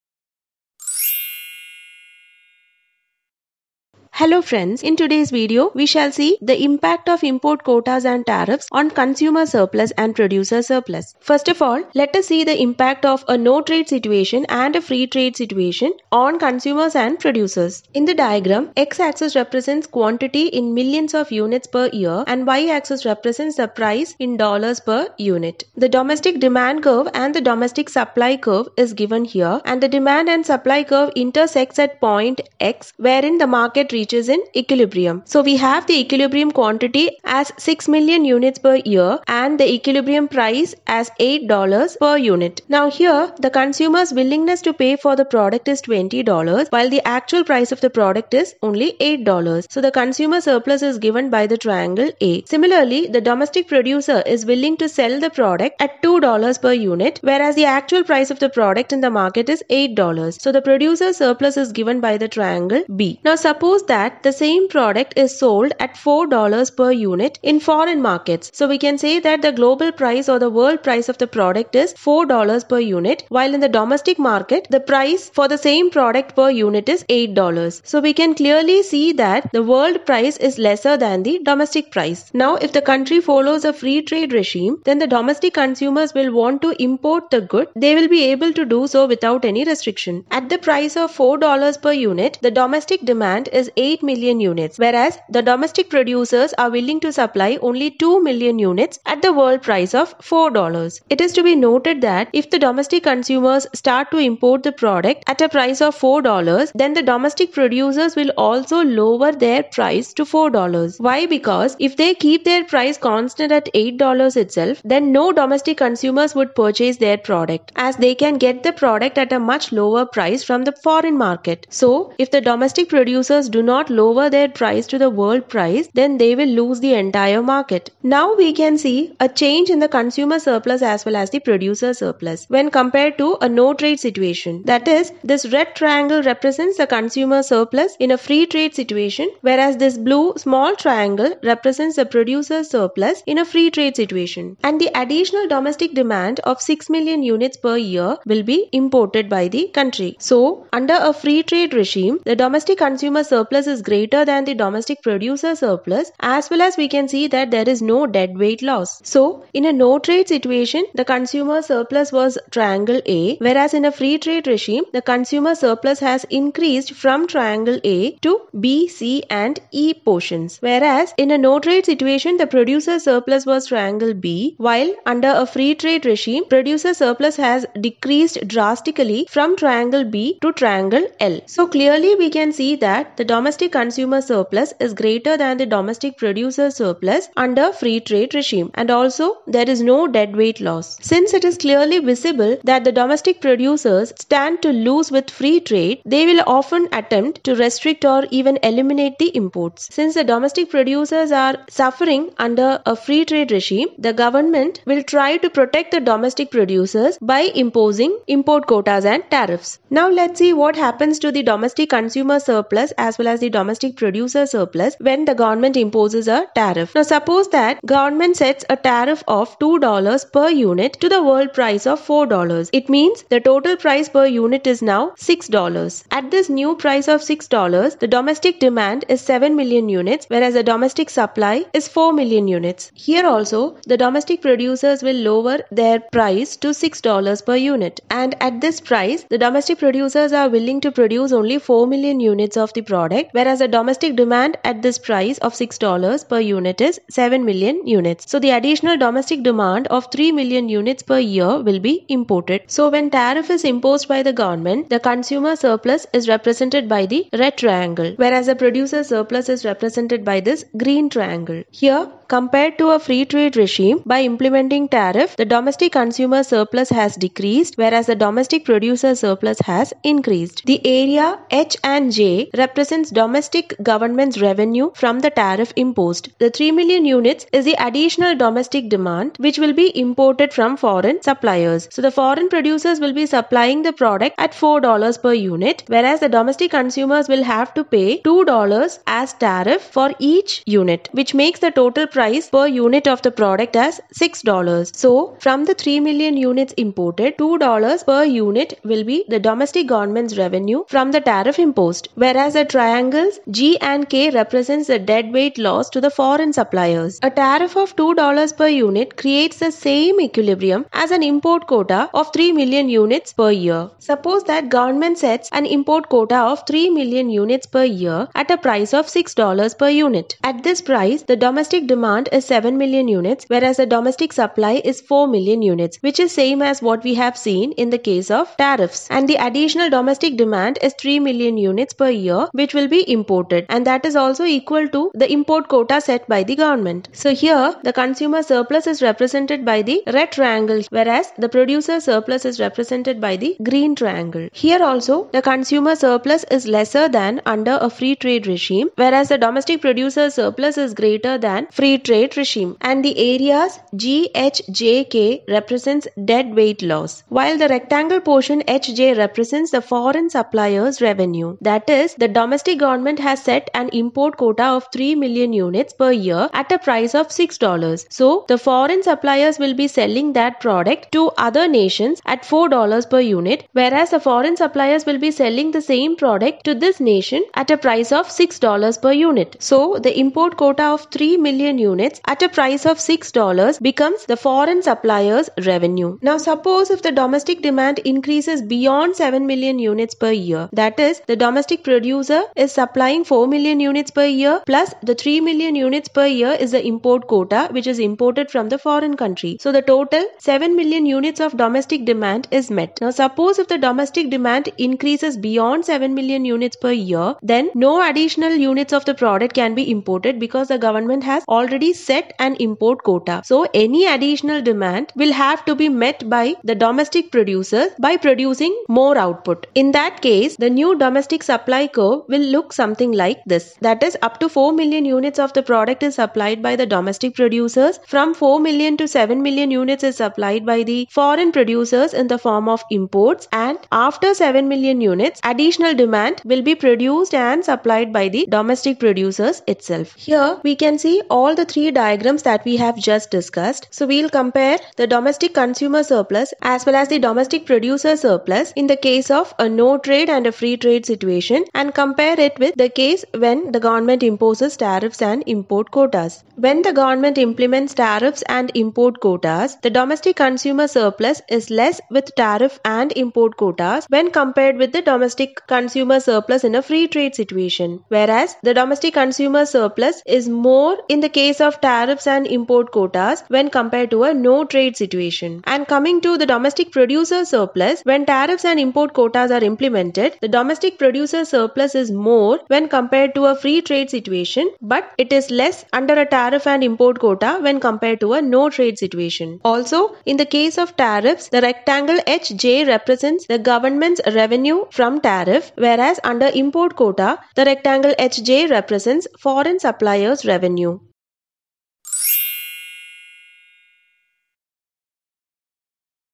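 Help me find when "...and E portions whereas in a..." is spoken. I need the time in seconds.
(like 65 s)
169 s.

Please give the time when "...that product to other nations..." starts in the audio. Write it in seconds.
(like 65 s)
370 s.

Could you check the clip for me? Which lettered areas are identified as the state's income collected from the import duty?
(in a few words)
H and J.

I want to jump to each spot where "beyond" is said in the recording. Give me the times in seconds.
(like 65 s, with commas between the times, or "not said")
388 s, 405 s.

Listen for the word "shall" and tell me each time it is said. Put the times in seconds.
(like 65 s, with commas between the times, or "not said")
5 s.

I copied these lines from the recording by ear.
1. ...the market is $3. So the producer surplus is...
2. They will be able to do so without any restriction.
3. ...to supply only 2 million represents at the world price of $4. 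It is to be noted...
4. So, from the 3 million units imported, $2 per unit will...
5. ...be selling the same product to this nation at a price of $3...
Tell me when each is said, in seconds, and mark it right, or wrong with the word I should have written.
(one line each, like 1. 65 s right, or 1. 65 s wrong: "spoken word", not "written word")
1. 59 s wrong: "8", not "3"
2. 87 s right
3. 97 s wrong: "units", not "represents"
4. 295 s right
5. 375 s wrong: "6", not "3".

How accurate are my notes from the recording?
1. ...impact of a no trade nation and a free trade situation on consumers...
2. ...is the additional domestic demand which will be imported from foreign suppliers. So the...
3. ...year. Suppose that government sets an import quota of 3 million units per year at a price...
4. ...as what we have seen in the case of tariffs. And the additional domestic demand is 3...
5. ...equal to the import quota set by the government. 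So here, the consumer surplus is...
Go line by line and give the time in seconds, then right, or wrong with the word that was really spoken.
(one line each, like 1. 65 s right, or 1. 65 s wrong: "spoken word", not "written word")
1. 12 s wrong: "situation", not "nation"
2. 277 s right
3. 313 s right
4. 326 s right
5. 334 s right.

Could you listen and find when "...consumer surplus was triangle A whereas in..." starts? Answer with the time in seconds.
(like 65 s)
161 s.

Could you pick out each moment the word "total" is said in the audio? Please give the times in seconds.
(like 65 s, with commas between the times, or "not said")
223 s, 291 s, 399 s.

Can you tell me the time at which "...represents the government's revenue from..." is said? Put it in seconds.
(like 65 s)
492 s.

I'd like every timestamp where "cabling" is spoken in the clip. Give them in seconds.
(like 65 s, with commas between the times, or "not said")
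not said.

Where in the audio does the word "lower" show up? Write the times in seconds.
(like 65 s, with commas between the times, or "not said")
108 s, 119 s, 124 s, 235 s.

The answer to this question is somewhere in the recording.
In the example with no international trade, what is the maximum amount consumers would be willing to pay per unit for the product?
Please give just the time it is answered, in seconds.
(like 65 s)
45 s.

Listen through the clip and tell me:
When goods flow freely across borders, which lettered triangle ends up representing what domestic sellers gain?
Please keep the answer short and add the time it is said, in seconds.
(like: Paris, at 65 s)
triangle L, at 180 s.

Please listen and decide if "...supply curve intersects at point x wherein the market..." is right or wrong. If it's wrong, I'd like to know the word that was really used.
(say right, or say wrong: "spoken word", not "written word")
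right.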